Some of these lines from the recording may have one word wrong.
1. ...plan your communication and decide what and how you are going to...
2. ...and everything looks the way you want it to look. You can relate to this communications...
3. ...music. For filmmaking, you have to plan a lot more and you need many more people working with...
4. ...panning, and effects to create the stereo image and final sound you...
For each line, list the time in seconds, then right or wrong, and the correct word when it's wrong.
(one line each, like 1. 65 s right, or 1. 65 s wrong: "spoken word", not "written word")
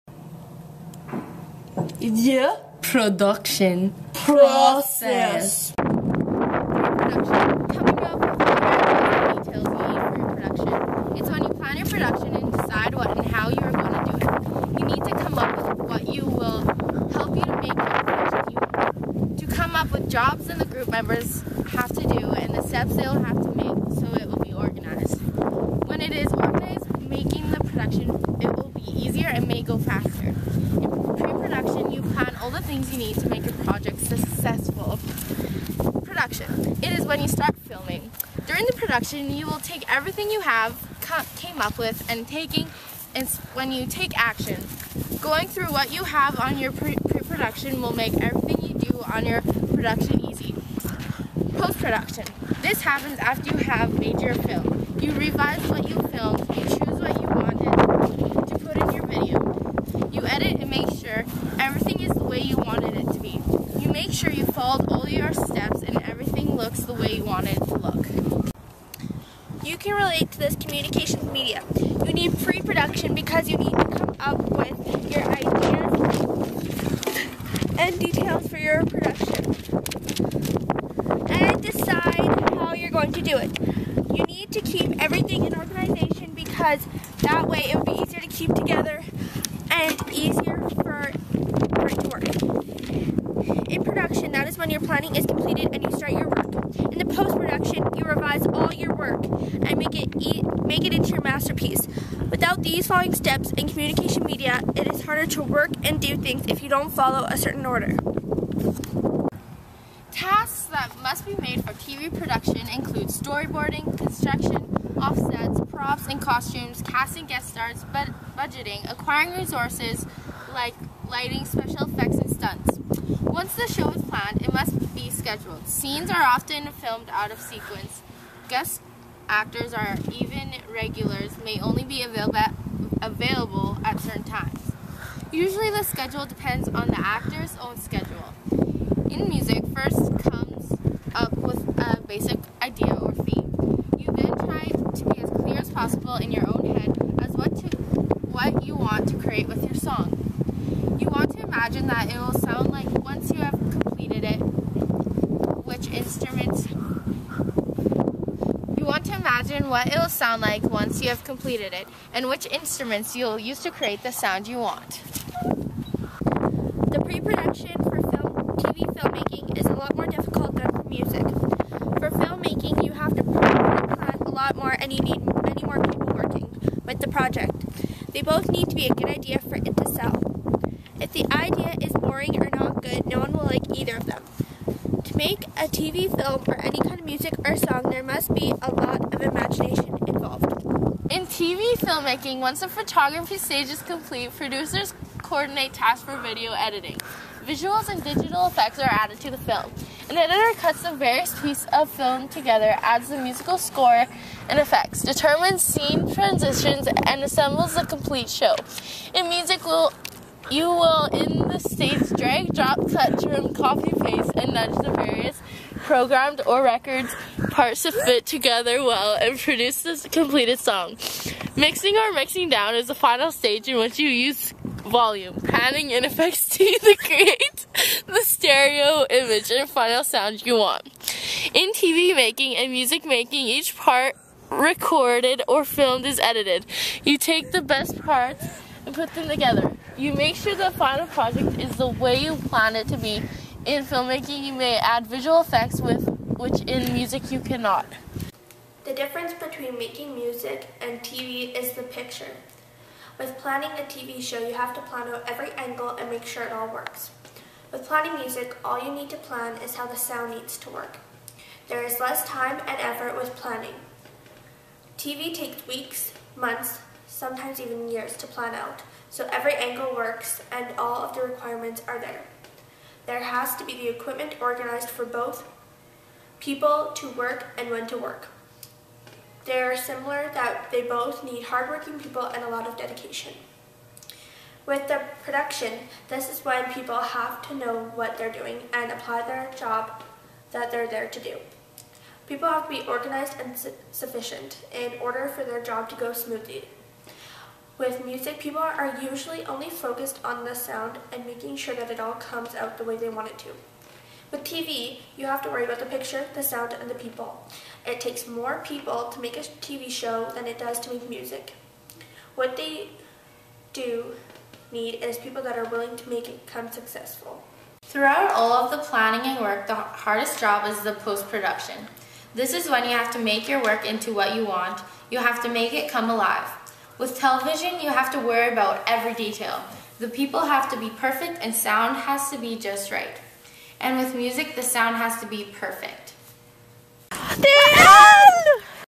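1. 11 s wrong: "production", not "communication"
2. 65 s right
3. 170 s right
4. 225 s right.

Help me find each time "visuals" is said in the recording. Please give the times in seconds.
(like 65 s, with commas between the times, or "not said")
197 s, 245 s.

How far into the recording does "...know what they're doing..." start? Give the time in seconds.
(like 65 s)
287 s.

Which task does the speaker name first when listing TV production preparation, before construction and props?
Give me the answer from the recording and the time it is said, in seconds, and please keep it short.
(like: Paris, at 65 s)
Storyboarding, at 113 s.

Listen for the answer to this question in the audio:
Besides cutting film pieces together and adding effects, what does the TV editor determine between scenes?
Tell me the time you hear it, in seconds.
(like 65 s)
205 s.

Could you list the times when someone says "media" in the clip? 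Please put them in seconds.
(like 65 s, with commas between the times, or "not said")
71 s, 104 s.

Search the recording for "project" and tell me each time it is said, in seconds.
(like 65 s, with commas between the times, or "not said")
33 s, 177 s, 241 s.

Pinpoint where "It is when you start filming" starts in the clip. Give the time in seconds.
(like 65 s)
36 s.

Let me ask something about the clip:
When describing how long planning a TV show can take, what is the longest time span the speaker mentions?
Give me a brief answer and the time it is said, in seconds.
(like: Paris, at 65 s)
Years, at 267 s.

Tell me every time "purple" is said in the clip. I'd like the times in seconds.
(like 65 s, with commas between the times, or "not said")
not said.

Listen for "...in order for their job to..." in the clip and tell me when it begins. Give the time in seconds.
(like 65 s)
294 s.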